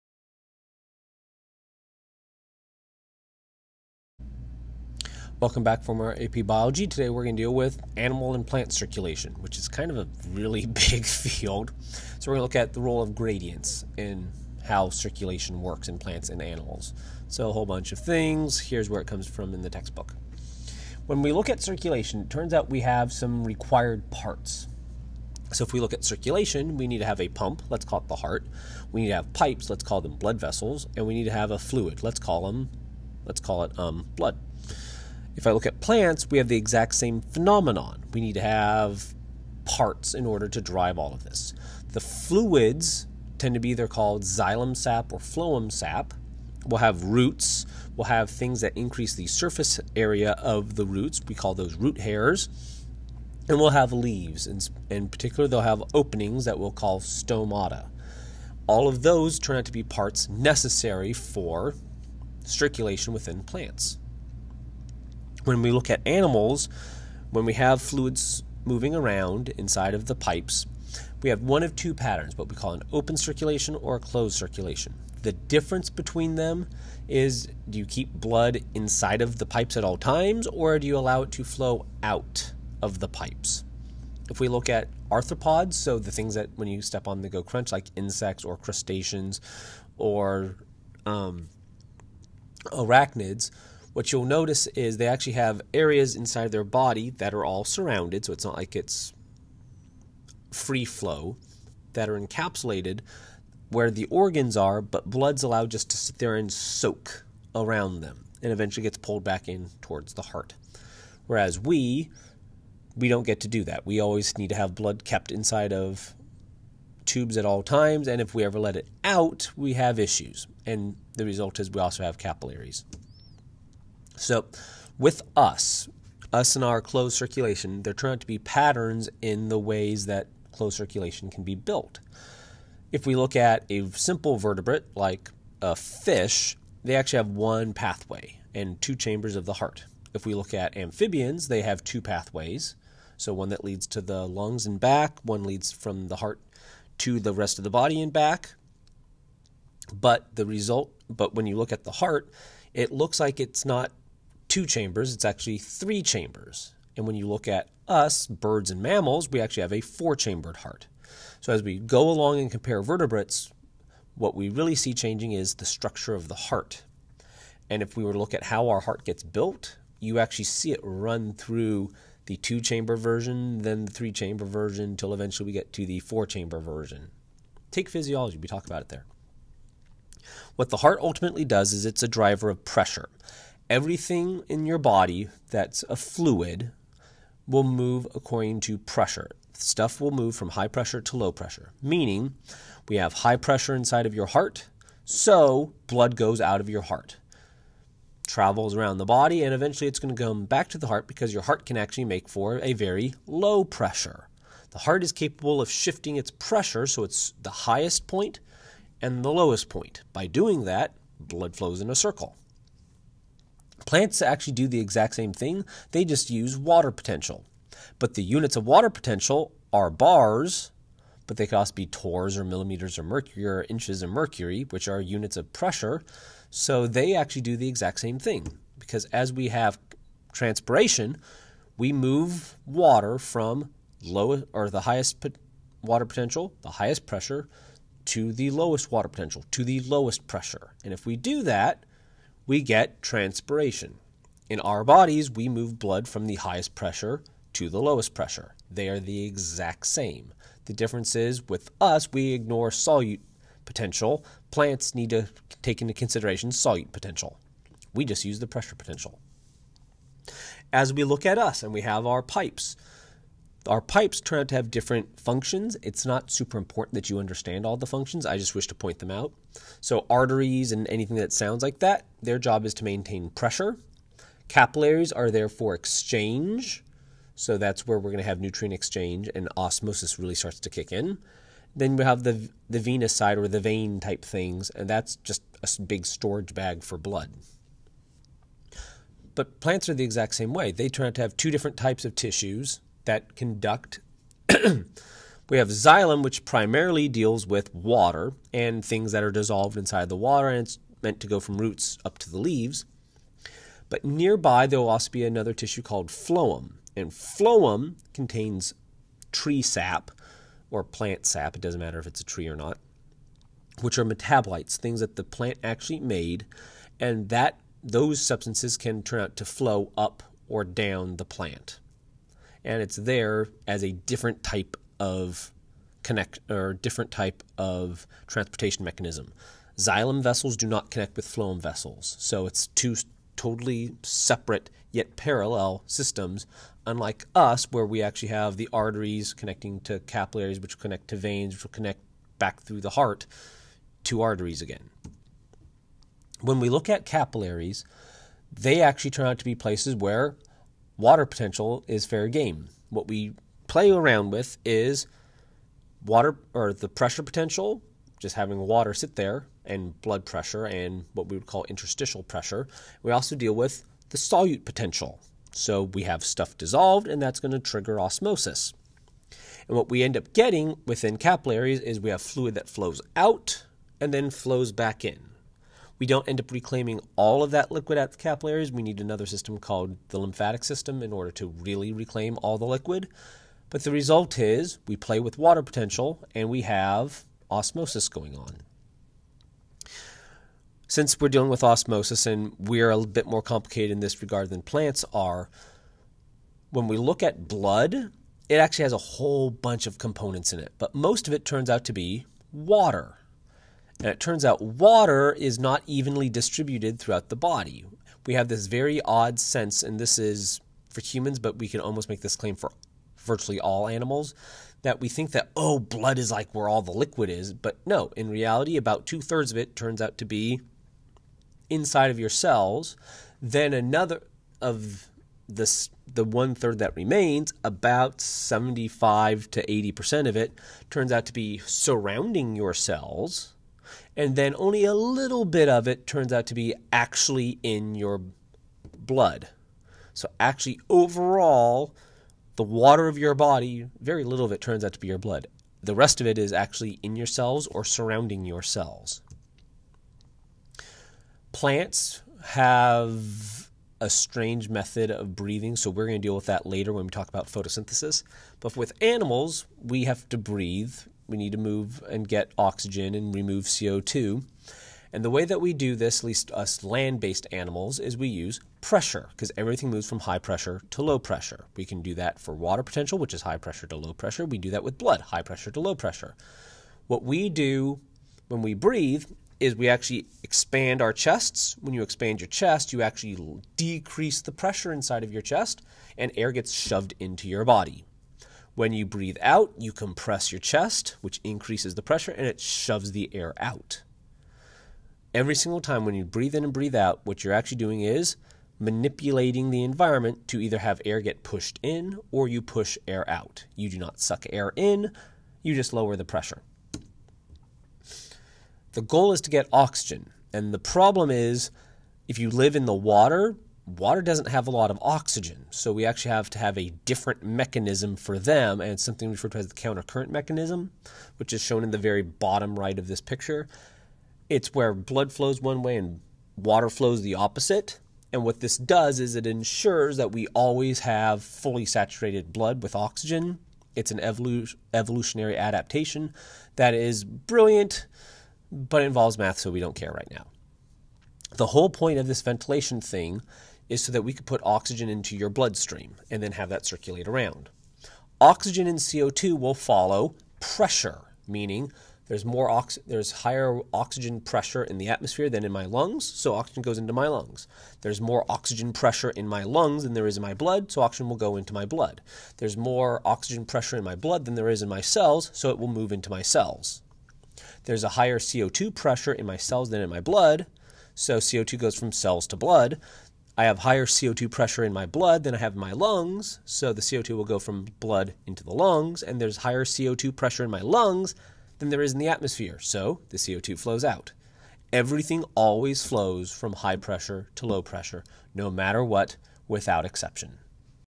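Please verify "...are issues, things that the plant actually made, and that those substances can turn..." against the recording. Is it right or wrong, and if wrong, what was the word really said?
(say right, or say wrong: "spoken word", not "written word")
wrong: "metabolites", not "issues".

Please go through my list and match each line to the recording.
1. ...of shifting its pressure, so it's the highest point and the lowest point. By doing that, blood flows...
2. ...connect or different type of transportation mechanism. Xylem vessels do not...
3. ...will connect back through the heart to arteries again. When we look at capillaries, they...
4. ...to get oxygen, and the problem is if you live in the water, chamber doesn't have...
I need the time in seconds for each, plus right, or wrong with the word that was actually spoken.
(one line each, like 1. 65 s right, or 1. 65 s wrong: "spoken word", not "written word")
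1. 205 s right
2. 326 s right
3. 341 s right
4. 509 s wrong: "water", not "chamber".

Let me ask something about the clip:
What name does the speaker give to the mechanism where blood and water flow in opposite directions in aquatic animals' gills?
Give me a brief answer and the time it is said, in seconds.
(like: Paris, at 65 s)
Countercurrent mechanism, at 519 s.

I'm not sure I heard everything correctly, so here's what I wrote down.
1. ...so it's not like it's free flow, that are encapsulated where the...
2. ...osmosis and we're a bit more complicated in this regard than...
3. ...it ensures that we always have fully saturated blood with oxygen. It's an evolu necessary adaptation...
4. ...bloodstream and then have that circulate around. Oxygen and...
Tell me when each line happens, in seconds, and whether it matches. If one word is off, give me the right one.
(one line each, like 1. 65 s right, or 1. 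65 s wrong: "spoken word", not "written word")
1. 98 s right
2. 391 s right
3. 529 s wrong: "evolutionary", not "necessary"
4. 545 s right.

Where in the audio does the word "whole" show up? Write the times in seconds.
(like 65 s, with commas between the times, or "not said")
17 s, 398 s, 541 s.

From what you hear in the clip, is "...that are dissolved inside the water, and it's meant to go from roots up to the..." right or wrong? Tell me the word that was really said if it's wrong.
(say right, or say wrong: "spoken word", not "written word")
right.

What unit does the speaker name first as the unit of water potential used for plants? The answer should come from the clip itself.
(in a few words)
Bars.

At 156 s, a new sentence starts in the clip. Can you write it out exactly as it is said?
And when you look at us, birds and mammals, we actually have a four chambered heart.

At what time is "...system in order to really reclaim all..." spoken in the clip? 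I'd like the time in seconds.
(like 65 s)
380 s.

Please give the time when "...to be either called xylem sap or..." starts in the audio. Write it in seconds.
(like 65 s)
43 s.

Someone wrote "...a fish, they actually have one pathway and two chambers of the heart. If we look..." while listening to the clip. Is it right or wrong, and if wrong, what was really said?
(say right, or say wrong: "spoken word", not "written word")
right.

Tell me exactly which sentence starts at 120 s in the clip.
And the result is we also have capillaries.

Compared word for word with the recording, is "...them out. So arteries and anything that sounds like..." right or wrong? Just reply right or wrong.
right.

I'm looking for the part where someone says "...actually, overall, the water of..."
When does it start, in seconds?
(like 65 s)
440 s.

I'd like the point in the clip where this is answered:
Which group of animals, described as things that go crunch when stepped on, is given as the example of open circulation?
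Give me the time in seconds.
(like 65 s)
85 s.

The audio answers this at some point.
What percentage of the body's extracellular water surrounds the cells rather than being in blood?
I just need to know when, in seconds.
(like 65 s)
428 s.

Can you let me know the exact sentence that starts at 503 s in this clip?
You do not suck air in, you just lower the pressure.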